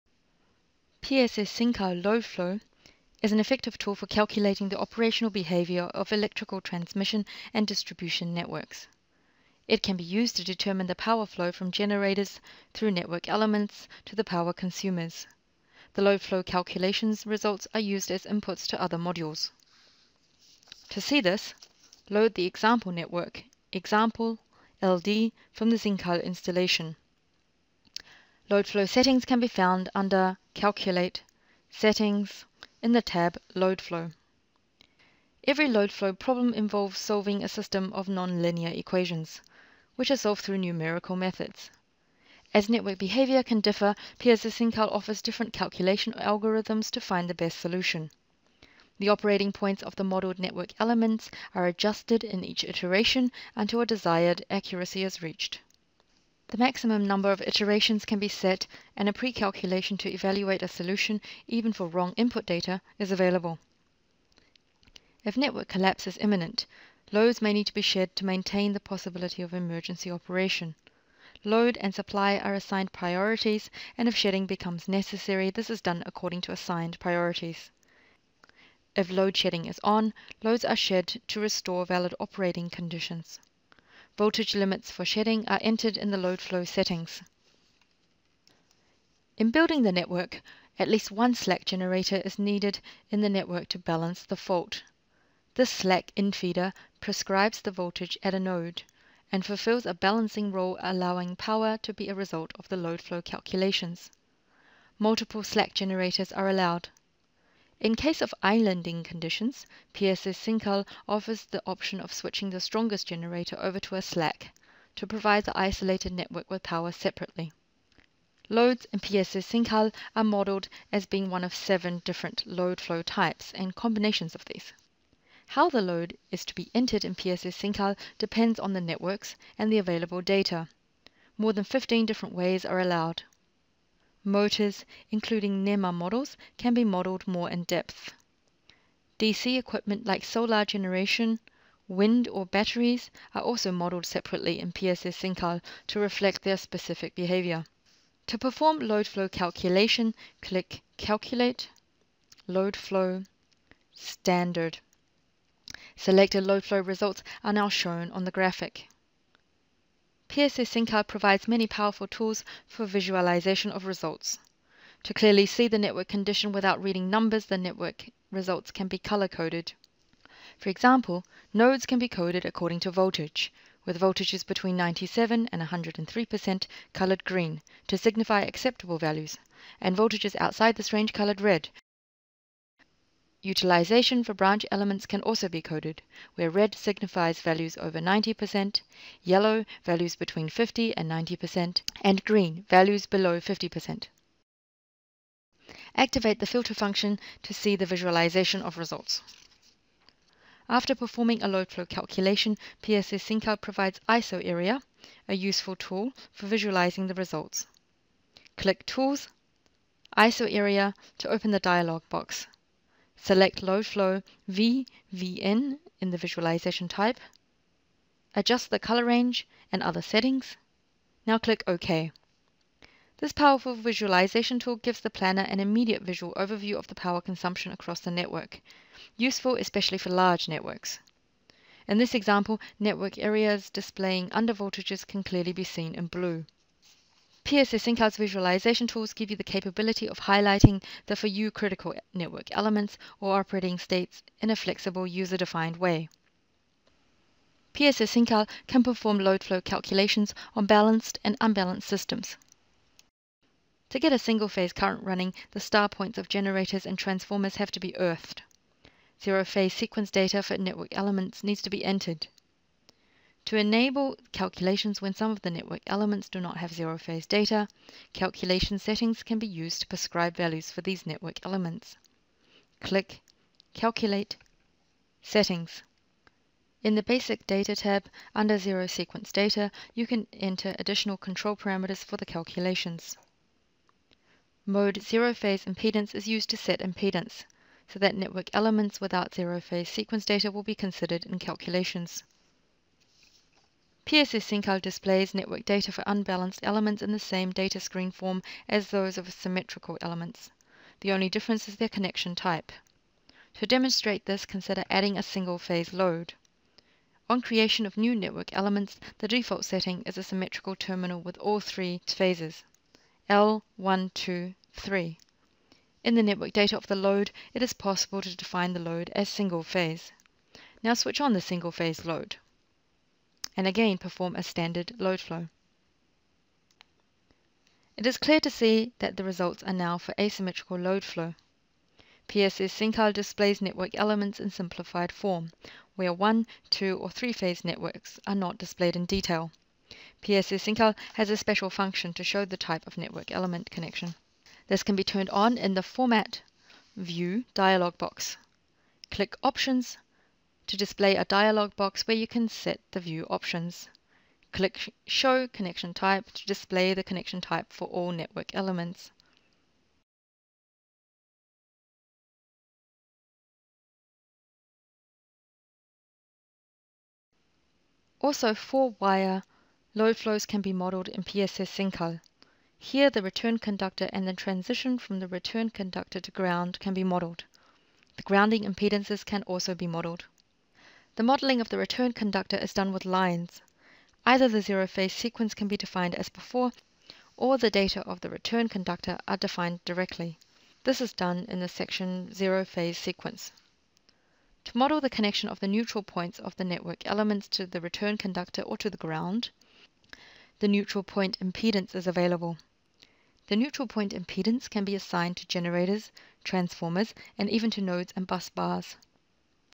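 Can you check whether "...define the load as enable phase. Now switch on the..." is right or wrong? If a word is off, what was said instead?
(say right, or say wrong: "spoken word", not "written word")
wrong: "single", not "enable".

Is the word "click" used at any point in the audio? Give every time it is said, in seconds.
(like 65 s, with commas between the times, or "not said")
150 s, 208 s, 221 s, 272 s, 349 s, 354 s.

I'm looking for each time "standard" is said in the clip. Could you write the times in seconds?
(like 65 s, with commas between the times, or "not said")
153 s, 324 s.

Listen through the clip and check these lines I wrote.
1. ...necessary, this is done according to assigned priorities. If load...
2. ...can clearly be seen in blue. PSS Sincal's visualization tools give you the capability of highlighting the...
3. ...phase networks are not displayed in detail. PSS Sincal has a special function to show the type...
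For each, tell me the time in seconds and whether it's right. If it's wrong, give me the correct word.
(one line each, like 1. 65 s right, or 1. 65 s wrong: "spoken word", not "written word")
1. 74 s right
2. 235 s right
3. 337 s right.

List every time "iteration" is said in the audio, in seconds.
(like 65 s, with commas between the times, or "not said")
52 s, 57 s.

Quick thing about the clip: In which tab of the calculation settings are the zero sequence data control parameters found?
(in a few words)
Basic Data.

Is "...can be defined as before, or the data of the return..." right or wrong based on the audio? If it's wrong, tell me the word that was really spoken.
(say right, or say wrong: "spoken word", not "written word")
right.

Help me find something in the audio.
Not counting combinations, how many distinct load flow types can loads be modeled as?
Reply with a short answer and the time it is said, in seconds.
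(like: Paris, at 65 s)
7, at 121 s.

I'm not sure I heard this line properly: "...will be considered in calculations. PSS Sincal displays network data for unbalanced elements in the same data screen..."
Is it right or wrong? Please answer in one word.
right.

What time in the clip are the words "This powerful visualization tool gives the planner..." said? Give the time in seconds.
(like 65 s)
223 s.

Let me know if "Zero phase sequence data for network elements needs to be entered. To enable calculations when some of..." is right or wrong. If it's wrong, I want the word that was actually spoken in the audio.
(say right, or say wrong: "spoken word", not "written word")
right.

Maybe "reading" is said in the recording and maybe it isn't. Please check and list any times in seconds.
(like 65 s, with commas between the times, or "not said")
166 s.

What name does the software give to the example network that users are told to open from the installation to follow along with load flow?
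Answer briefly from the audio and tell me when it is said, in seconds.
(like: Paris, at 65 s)
example LD, at 23 s.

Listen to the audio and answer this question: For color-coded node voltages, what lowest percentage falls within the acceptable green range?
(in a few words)
97%.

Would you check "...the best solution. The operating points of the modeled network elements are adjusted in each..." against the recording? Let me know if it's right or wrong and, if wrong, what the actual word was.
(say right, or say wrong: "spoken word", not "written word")
right.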